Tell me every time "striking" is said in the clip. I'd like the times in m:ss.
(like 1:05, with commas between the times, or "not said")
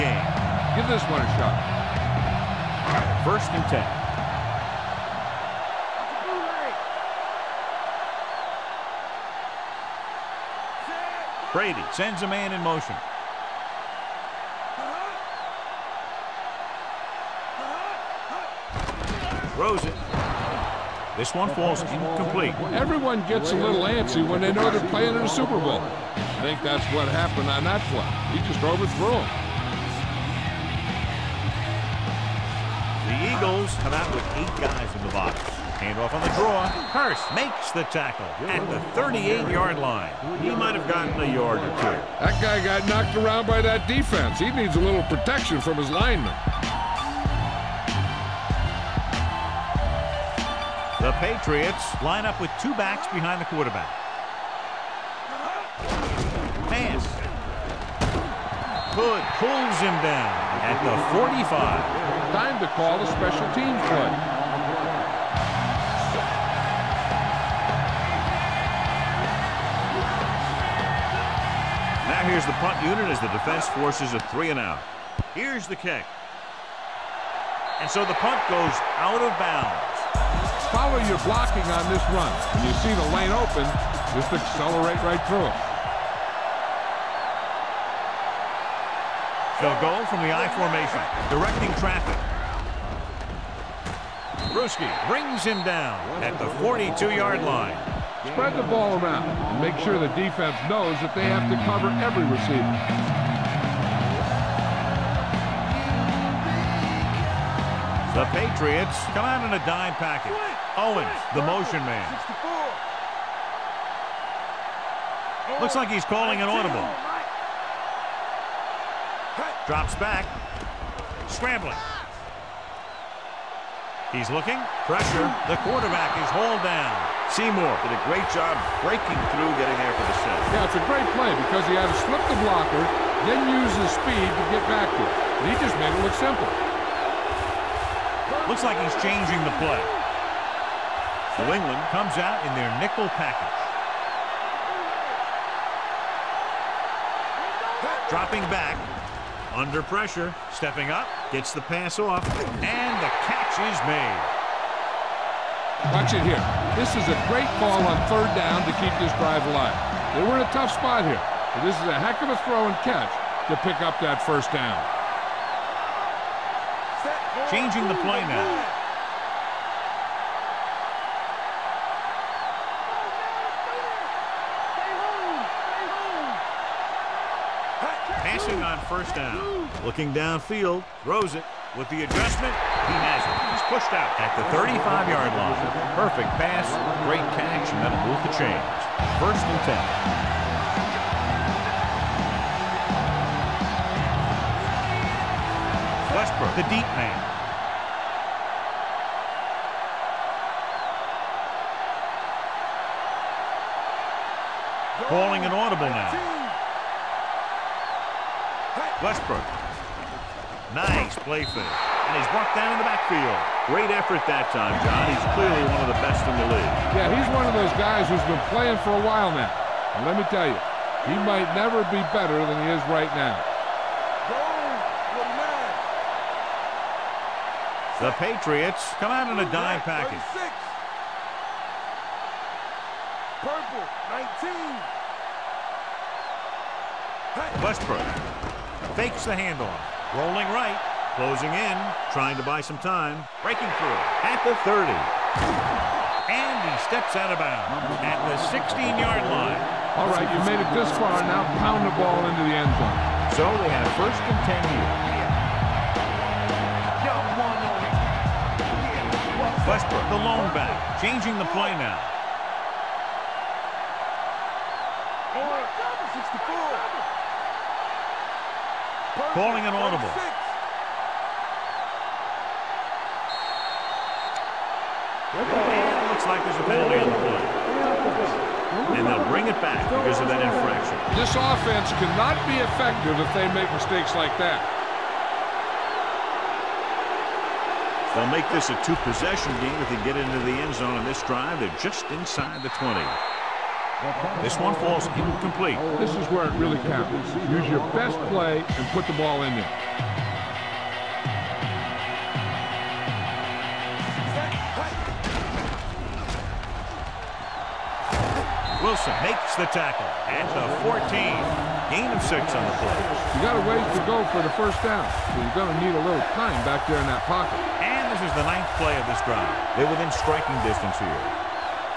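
5:20.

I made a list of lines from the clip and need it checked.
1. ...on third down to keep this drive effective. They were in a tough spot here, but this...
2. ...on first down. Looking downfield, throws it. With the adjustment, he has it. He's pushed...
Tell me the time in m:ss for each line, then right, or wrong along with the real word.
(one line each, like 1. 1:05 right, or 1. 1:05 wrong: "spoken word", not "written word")
1. 2:37 wrong: "alive", not "effective"
2. 2:58 right.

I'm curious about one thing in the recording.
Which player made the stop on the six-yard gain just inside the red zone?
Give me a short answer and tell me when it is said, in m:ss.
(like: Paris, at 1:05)
Wilson, at 5:08.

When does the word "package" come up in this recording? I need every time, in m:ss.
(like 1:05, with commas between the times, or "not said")
1:50, 2:23, 3:49.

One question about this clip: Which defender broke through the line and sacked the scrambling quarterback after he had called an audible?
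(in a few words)
Seymour.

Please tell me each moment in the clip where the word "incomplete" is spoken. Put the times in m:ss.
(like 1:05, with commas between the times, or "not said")
0:21, 4:55.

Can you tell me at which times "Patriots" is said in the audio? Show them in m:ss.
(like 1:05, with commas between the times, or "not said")
0:51, 1:48, 3:48.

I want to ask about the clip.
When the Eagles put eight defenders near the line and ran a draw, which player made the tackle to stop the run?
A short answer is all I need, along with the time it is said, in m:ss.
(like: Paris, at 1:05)
Hurst, at 0:36.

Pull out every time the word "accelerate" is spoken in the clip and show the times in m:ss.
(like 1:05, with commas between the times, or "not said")
1:24.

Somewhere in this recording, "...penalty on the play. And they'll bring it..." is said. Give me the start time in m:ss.
4:36.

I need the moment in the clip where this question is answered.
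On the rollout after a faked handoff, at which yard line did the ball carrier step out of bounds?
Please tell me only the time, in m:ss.
4:08.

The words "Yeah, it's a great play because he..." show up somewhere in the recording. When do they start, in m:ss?
2:10.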